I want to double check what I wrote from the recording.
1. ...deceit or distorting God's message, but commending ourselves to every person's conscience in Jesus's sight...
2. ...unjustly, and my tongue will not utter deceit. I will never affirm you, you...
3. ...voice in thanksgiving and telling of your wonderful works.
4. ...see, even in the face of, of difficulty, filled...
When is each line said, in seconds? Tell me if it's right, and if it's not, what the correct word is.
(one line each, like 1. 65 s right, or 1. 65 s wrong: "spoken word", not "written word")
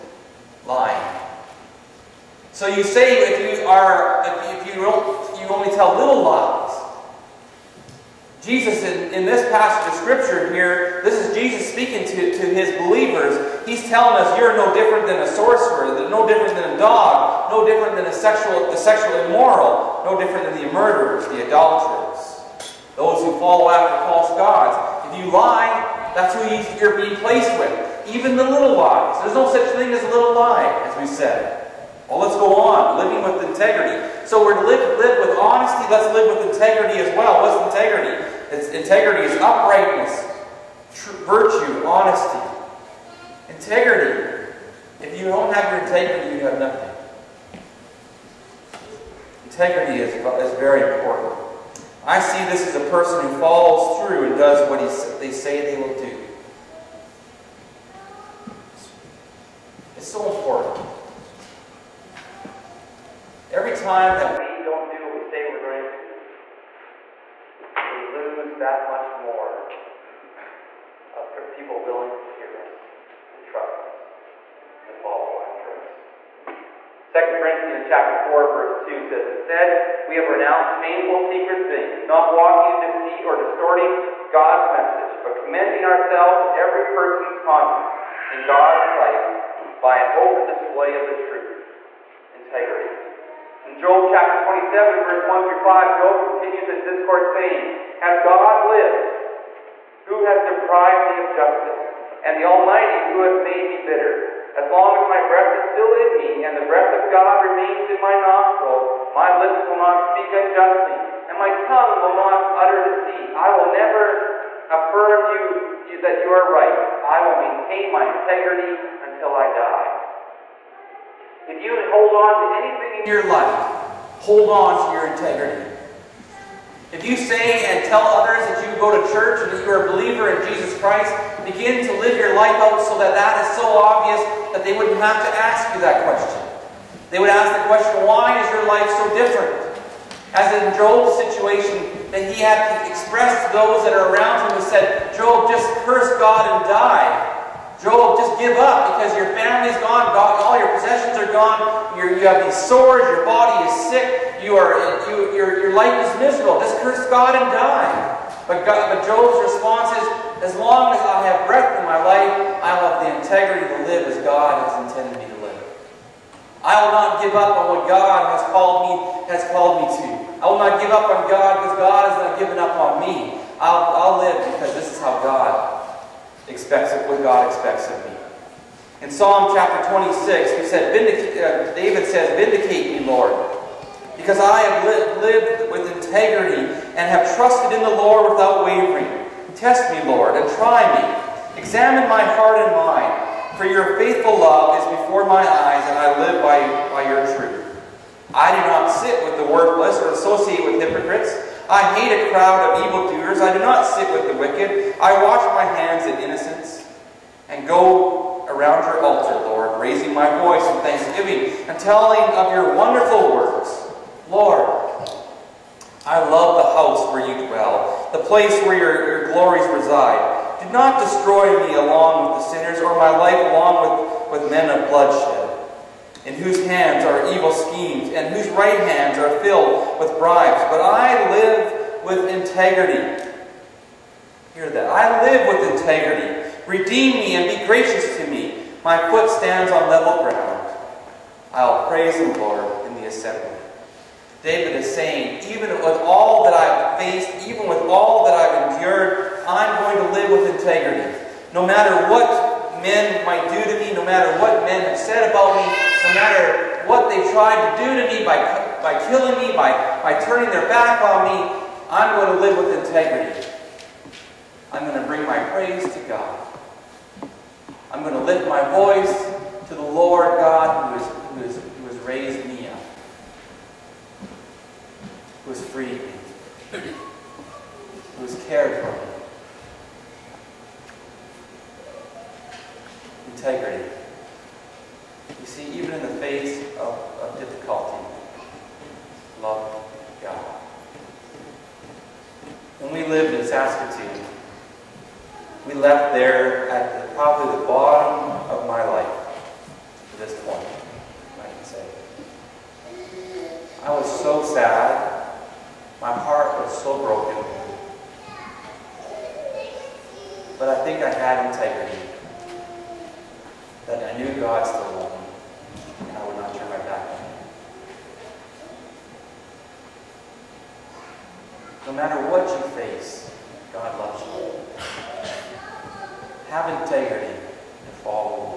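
1. 82 s wrong: "God", not "Jesus"
2. 110 s right
3. 210 s right
4. 285 s wrong: "loved", not "filled".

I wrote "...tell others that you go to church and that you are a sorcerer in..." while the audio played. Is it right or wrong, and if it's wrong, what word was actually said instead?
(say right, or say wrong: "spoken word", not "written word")
wrong: "believer", not "sorcerer".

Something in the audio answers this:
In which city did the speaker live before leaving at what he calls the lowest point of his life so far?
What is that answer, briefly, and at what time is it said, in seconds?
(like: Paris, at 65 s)
Saskatoon, at 293 s.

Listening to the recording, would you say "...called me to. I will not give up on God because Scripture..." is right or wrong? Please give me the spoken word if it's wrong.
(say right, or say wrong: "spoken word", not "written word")
wrong: "God", not "Scripture".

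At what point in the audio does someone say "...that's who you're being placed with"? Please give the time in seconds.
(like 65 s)
26 s.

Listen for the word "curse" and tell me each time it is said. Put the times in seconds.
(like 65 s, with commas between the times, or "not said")
145 s, 156 s.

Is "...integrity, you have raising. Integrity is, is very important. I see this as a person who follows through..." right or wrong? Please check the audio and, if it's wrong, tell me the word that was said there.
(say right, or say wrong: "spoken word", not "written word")
wrong: "nothing", not "raising".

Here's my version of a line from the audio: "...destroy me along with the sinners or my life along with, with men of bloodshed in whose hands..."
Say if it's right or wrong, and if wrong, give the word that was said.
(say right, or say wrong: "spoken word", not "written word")
right.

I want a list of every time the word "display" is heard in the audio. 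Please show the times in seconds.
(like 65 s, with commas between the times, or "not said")
90 s.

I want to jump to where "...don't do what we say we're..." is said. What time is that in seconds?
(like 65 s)
64 s.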